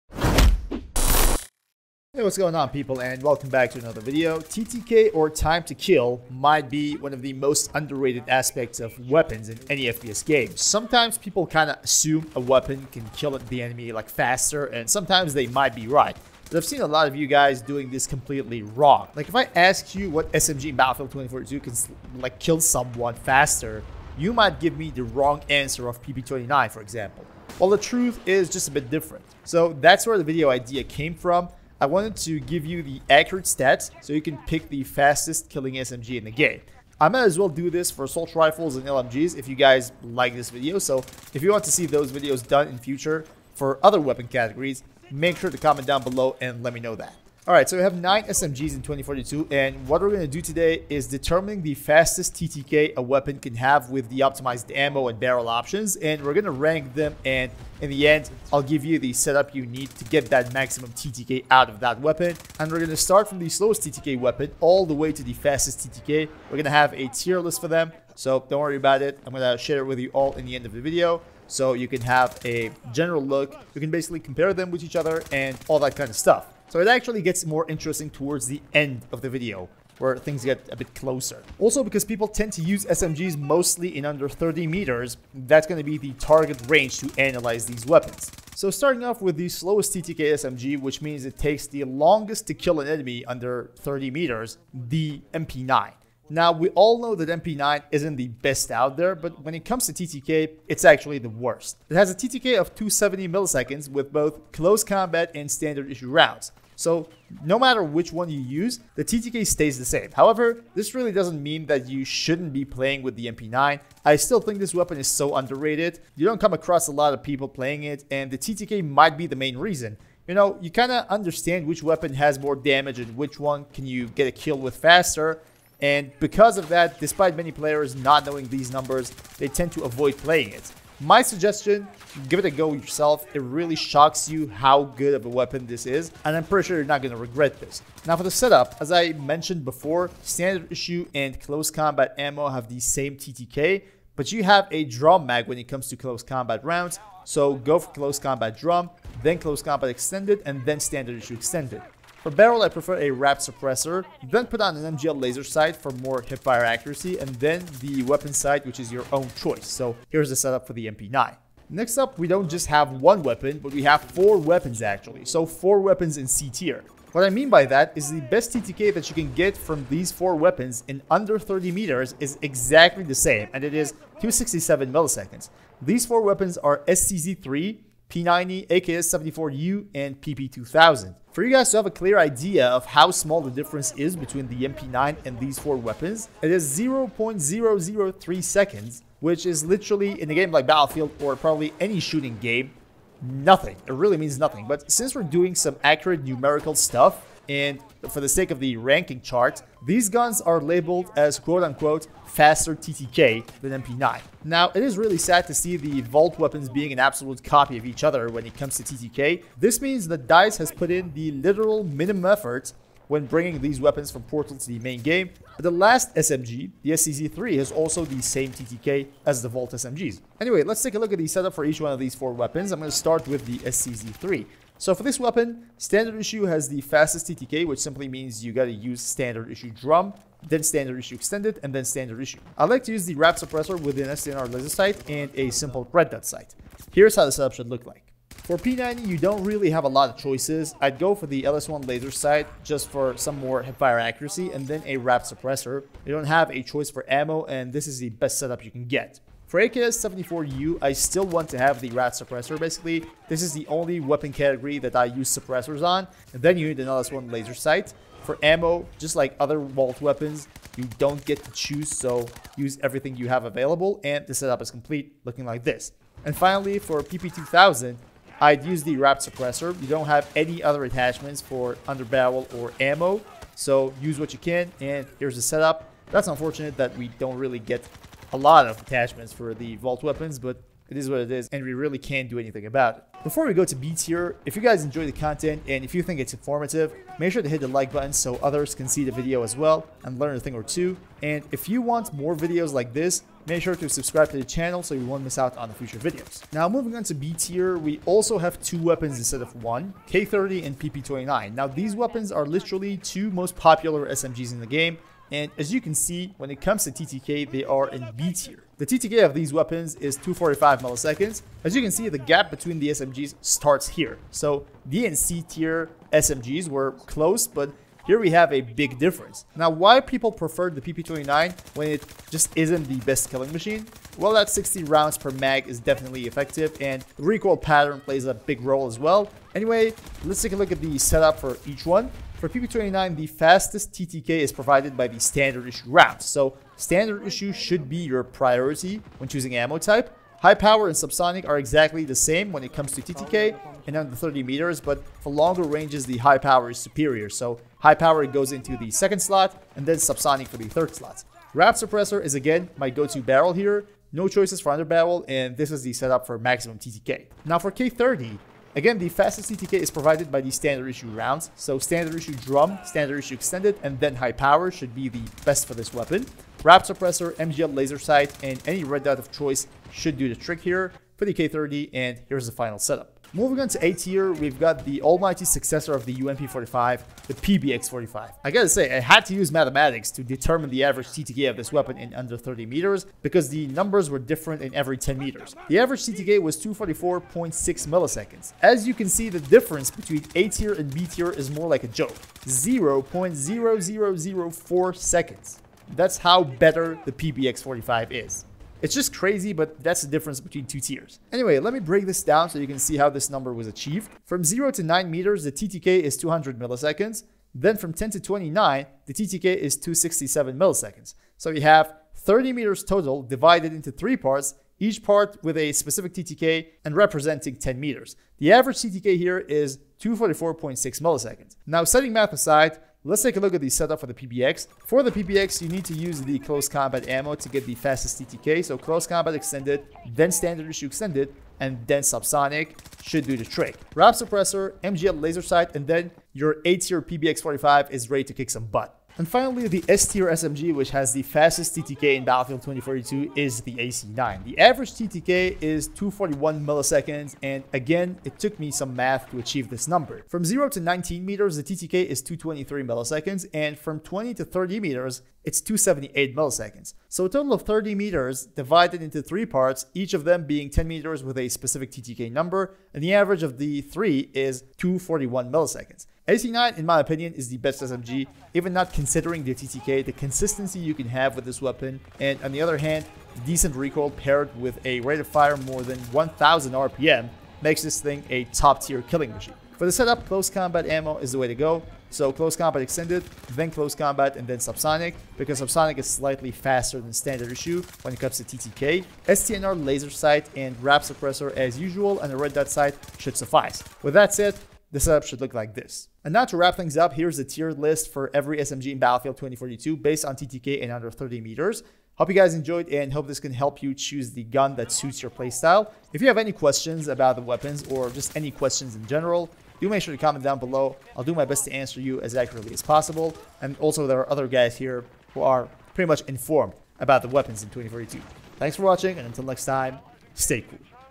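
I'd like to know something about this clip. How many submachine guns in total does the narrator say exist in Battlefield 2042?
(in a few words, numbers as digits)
9.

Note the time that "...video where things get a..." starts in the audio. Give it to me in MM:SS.
01:19.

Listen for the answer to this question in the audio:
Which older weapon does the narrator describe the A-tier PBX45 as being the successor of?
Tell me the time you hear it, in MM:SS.
06:16.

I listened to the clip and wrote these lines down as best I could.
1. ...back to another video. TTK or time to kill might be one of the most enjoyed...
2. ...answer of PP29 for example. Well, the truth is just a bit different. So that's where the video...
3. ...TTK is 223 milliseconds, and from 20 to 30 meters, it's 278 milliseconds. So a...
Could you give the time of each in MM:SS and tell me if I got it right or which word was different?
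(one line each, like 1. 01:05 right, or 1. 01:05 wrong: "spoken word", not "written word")
1. 00:03 wrong: "underrated", not "enjoyed"
2. 00:25 right
3. 07:31 right.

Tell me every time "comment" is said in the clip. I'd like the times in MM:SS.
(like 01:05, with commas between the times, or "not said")
00:45, 08:30.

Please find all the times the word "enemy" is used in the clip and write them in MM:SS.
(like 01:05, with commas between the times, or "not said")
00:13, 01:32.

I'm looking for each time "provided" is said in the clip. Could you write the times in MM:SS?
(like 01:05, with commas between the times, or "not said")
05:34, 05:59.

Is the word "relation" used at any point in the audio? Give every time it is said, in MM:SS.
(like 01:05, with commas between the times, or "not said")
not said.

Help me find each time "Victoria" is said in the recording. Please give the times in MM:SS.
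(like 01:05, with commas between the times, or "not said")
not said.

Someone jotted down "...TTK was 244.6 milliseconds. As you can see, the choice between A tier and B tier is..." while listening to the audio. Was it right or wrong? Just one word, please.
wrong.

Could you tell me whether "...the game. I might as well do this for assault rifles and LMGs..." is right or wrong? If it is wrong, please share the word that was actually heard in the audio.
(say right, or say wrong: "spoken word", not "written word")
right.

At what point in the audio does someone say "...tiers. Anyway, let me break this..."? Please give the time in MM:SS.
06:40.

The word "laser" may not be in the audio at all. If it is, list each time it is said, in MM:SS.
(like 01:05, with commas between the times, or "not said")
02:35, 03:54, 04:01, 04:17, 06:07, 07:15, 08:09.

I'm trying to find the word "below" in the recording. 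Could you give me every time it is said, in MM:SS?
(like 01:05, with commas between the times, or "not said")
00:46, 08:30.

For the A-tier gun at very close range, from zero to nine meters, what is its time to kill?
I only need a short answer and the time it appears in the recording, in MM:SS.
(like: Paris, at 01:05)
200 milliseconds, at 06:46.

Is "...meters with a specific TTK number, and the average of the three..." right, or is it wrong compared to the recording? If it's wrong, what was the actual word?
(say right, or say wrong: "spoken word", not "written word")
right.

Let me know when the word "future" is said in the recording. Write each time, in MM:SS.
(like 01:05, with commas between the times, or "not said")
00:42, 04:55.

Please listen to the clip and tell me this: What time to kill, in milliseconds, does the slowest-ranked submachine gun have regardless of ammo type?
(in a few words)
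270.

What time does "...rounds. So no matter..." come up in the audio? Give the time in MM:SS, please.
01:46.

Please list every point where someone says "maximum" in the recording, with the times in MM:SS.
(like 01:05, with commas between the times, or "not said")
01:00, 05:56.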